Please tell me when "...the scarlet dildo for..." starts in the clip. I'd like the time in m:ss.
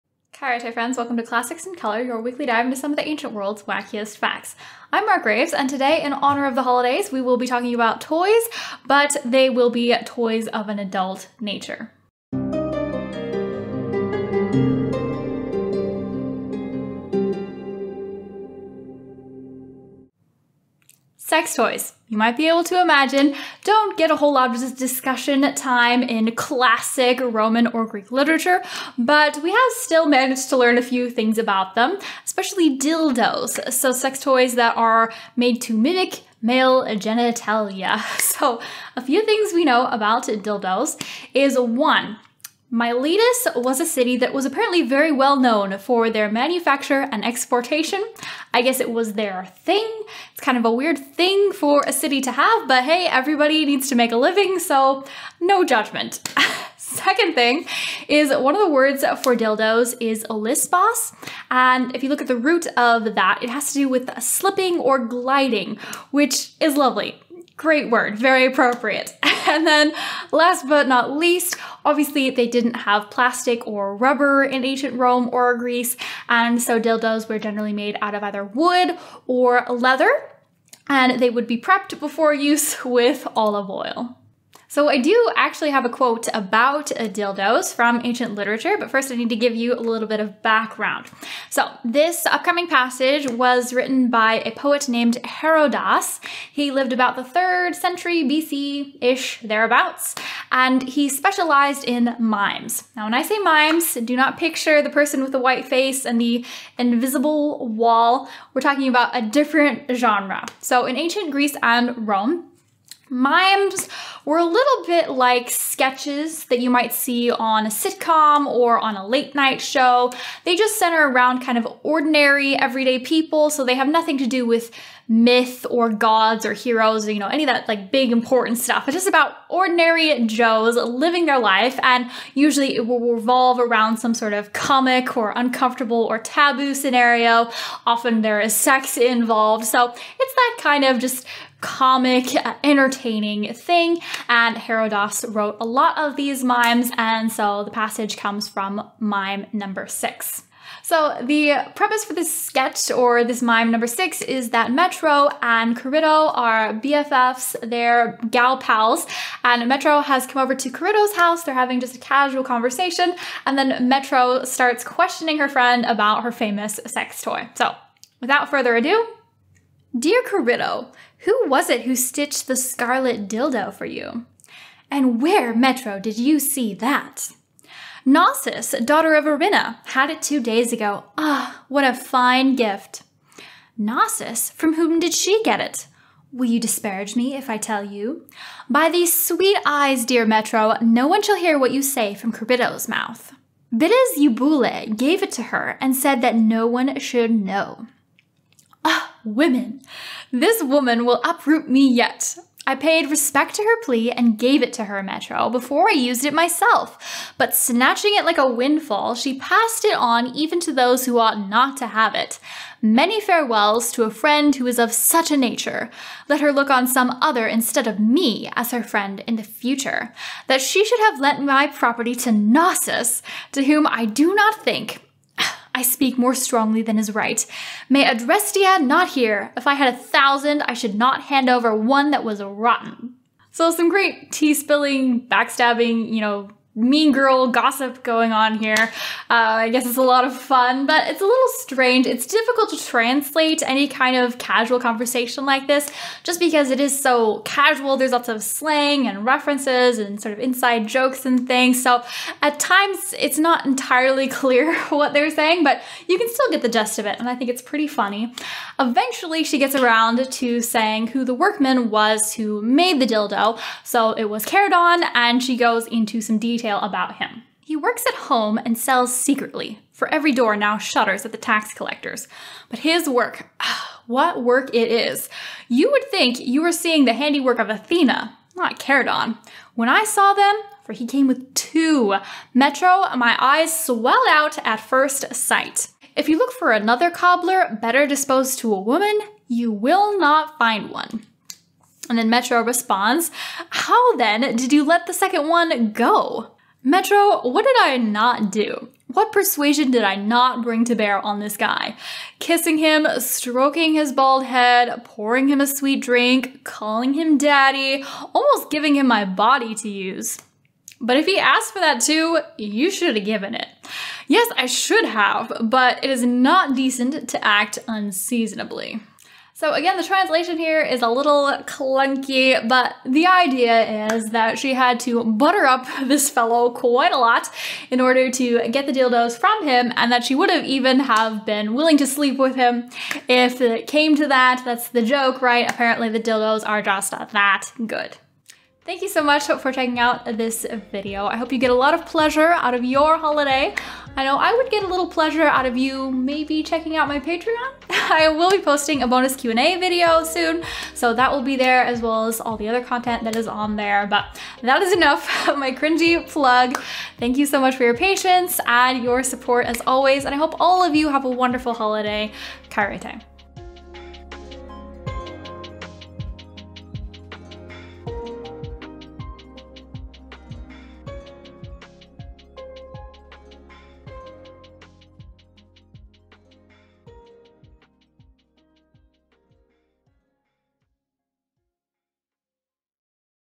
2:52.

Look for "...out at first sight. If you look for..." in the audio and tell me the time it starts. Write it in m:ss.
4:44.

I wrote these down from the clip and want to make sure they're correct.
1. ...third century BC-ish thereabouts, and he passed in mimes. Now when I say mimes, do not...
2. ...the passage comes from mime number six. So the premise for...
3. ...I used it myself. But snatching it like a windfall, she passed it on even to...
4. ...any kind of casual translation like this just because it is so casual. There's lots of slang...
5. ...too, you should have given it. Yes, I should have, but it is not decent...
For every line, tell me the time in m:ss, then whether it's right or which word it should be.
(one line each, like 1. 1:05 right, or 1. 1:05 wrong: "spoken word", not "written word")
1. 1:37 wrong: "specialized", not "passed"
2. 2:27 right
3. 3:25 right
4. 4:03 wrong: "conversation", not "translation"
5. 5:12 right.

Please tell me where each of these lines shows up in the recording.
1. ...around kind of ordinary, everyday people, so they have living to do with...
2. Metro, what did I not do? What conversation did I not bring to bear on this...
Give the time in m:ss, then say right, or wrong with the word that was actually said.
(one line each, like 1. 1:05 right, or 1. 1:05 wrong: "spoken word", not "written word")
1. 2:01 wrong: "nothing", not "living"
2. 4:56 wrong: "persuasion", not "conversation".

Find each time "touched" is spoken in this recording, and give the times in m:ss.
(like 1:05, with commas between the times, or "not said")
not said.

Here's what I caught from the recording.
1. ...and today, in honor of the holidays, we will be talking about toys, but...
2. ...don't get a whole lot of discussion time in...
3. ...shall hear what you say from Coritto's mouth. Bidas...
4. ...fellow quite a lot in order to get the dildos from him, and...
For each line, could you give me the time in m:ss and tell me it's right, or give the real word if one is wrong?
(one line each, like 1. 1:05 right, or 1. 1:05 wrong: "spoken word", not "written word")
1. 0:05 right
2. 0:23 right
3. 3:11 right
4. 5:26 right.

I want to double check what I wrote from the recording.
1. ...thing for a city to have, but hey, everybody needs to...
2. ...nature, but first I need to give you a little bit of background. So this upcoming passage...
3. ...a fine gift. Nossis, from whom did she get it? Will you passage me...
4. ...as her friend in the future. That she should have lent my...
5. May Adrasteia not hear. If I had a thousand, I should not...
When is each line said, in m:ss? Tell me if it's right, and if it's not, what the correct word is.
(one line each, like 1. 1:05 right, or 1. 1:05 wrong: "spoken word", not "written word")
1. 0:50 right
2. 1:28 wrong: "literature", not "nature"
3. 3:01 wrong: "disparage", not "passage"
4. 3:38 right
5. 3:47 right.